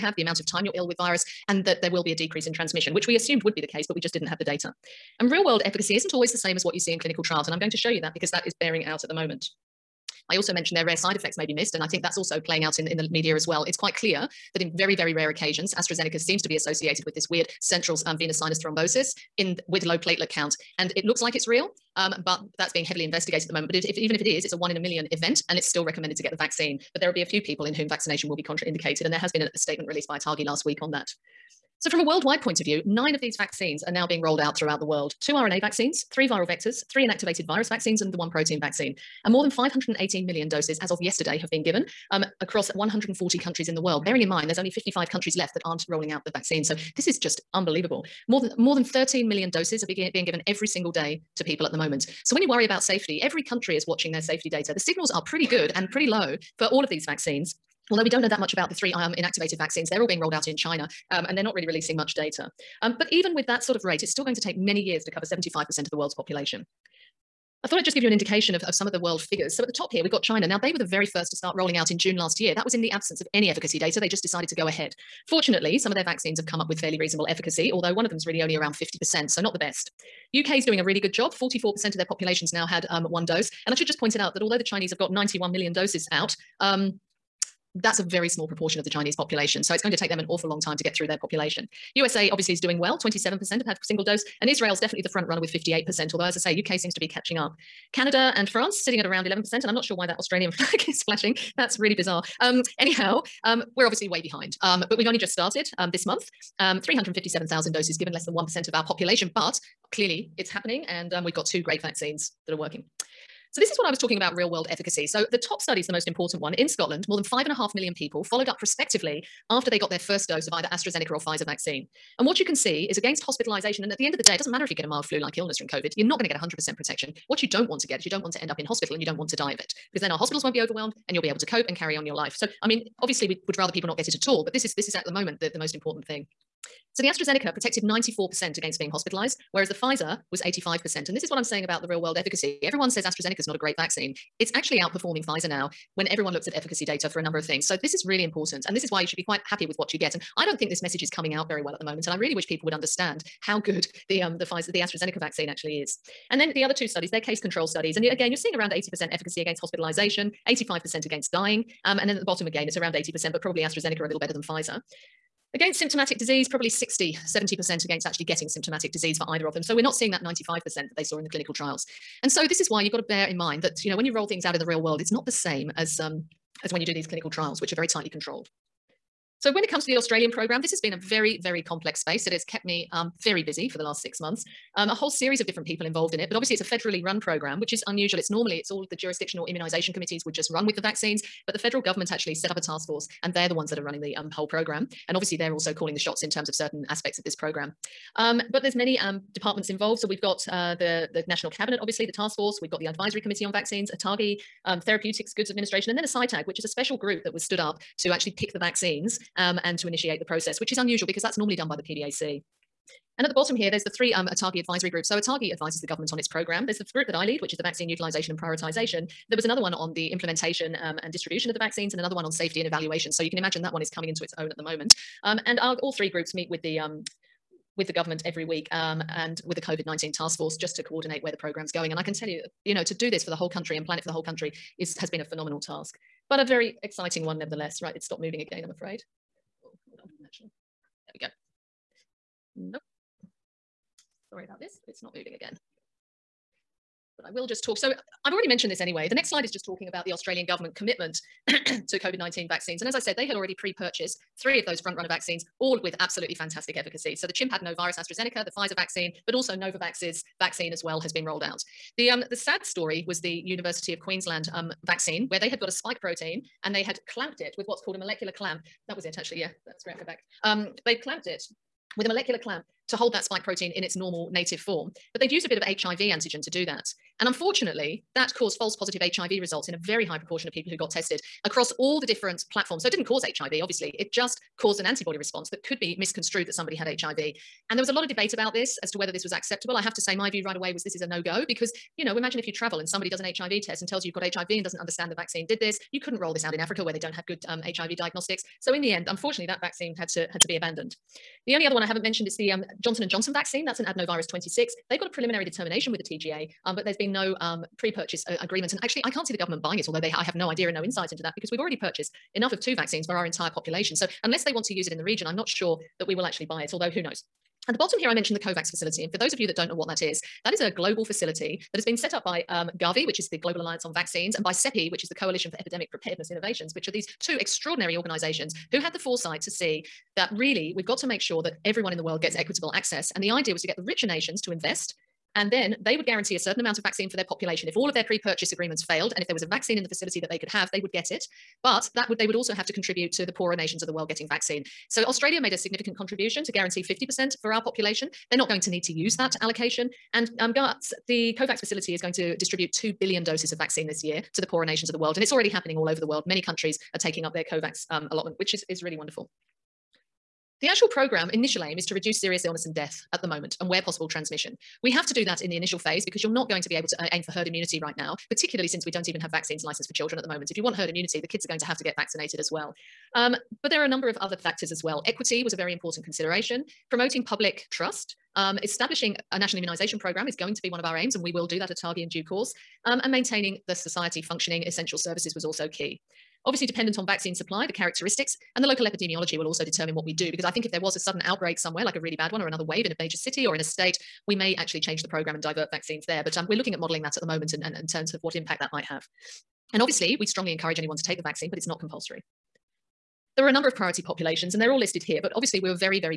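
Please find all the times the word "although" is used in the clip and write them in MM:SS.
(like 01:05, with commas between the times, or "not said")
00:57, 01:17, 01:24, 01:36, 05:09, 05:16.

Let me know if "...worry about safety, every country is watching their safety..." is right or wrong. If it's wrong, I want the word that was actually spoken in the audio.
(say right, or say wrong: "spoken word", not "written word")
right.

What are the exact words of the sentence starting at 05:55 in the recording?
And it's already happening all over the world.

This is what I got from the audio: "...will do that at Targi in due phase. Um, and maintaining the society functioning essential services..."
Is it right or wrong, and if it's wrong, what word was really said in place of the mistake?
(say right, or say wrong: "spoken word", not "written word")
wrong: "course", not "phase".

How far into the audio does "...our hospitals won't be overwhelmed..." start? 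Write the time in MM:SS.
02:10.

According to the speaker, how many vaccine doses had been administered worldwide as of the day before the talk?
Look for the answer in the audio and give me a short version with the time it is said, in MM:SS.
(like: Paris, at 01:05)
more than 518 million, at 00:39.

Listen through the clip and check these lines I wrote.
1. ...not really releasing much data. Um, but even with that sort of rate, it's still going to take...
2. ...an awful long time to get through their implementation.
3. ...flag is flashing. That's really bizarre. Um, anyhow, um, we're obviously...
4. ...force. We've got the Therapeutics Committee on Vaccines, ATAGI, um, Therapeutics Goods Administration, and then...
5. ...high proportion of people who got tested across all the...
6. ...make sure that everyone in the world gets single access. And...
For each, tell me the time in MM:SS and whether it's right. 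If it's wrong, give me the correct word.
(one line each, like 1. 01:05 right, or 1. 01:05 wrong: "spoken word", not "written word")
1. 01:01 right
2. 01:30 wrong: "population", not "implementation"
3. 01:40 right
4. 03:22 wrong: "Advisory", not "Therapeutics"
5. 04:40 right
6. 05:31 wrong: "equitable", not "single".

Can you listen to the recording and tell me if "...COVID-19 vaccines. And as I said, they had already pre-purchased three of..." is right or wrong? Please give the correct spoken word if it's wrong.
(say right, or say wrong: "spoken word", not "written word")
right.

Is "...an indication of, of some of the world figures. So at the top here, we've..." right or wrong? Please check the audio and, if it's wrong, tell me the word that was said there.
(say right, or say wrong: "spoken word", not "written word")
right.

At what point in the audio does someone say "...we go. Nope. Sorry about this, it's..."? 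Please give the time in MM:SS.
04:01.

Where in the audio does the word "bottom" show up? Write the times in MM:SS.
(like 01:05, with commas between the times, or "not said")
02:42, 03:33, 05:17.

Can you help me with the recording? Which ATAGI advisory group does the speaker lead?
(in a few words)
vaccine utilization and prioritization.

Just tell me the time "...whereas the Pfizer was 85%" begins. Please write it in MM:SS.
02:19.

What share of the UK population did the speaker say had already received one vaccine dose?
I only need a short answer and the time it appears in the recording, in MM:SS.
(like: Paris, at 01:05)
44%, at 01:21.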